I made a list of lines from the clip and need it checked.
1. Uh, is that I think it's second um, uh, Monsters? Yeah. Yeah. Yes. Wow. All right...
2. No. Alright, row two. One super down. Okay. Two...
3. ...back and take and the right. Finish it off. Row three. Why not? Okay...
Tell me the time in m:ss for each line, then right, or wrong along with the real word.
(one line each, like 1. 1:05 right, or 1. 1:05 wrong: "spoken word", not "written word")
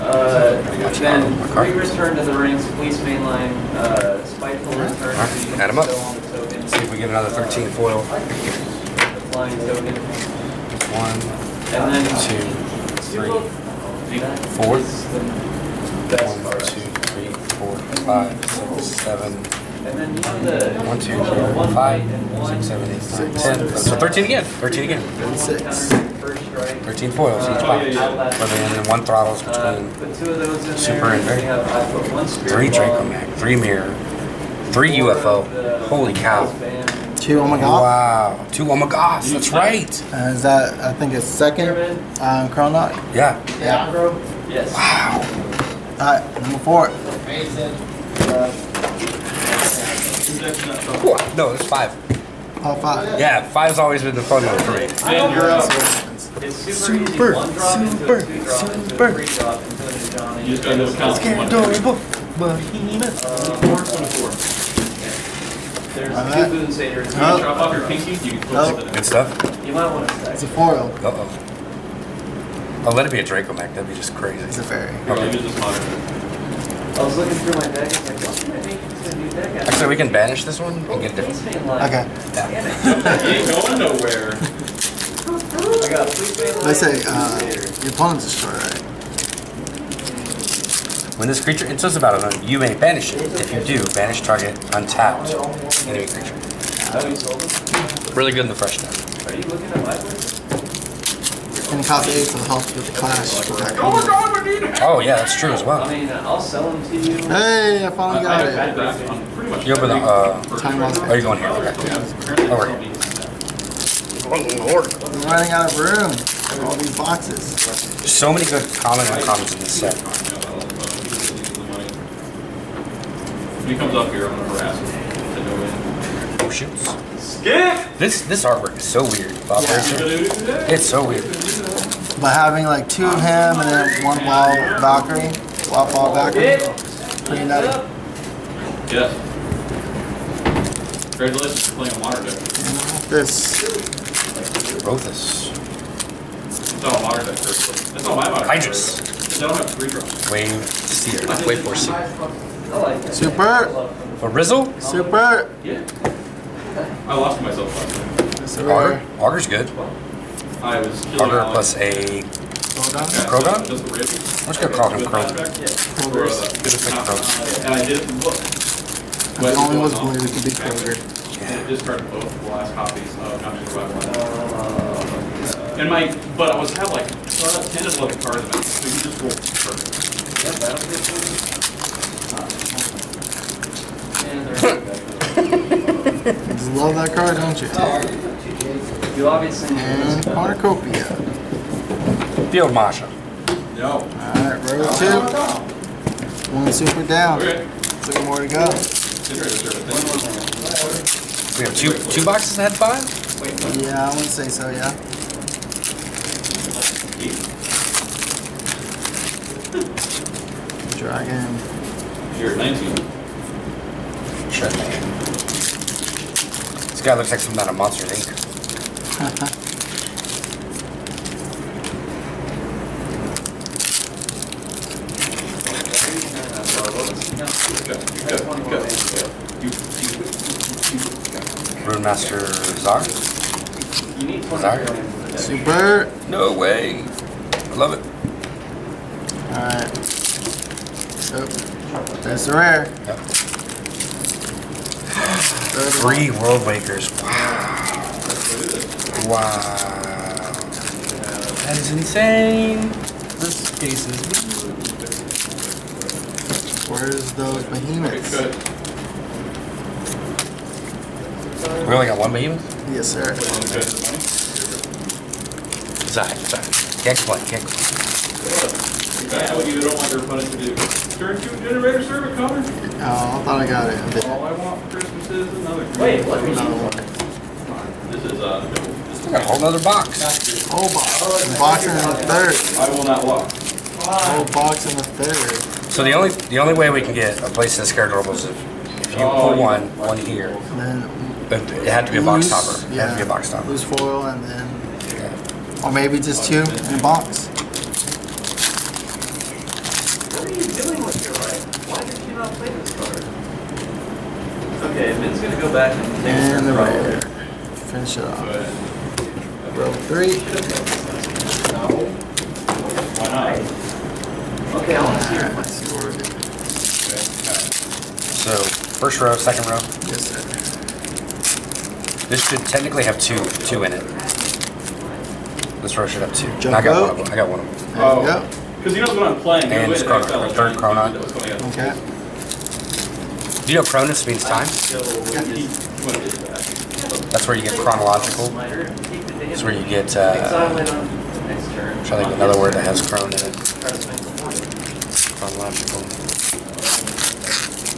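1. 0:40 wrong: "Chronoc", not "Monsters"
2. 3:13 right
3. 5:05 right.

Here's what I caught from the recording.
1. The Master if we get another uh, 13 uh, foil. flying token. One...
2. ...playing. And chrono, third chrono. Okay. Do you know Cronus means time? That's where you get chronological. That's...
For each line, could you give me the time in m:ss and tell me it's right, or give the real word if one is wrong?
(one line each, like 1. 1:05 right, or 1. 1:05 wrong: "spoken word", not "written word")
1. 0:05 wrong: "See", not "Master"
2. 5:29 right.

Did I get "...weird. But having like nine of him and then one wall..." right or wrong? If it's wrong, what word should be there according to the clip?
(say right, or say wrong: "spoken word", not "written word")
wrong: "two", not "nine".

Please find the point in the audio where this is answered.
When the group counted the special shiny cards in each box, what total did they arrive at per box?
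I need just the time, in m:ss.
0:26.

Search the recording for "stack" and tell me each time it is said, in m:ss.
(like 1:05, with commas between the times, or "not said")
1:10.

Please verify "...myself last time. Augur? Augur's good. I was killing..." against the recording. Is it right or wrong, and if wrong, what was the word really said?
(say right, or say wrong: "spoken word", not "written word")
right.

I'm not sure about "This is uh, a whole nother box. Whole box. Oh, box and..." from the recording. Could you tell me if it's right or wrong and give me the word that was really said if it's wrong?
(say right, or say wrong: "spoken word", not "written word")
right.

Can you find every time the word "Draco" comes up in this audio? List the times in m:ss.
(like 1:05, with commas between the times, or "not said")
0:32, 1:13.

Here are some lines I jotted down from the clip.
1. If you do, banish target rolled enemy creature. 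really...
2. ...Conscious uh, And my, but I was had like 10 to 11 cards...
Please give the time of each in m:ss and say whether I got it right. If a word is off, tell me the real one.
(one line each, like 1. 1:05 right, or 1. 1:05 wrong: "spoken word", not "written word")
1. 1:33 wrong: "untapped", not "rolled"
2. 2:53 right.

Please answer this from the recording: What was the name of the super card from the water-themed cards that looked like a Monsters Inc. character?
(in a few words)
Rune Master Czar.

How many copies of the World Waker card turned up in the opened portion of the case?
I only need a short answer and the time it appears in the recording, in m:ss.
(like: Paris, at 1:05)
3, at 4:05.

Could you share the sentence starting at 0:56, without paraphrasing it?
It's super, super, One drop super, into a super.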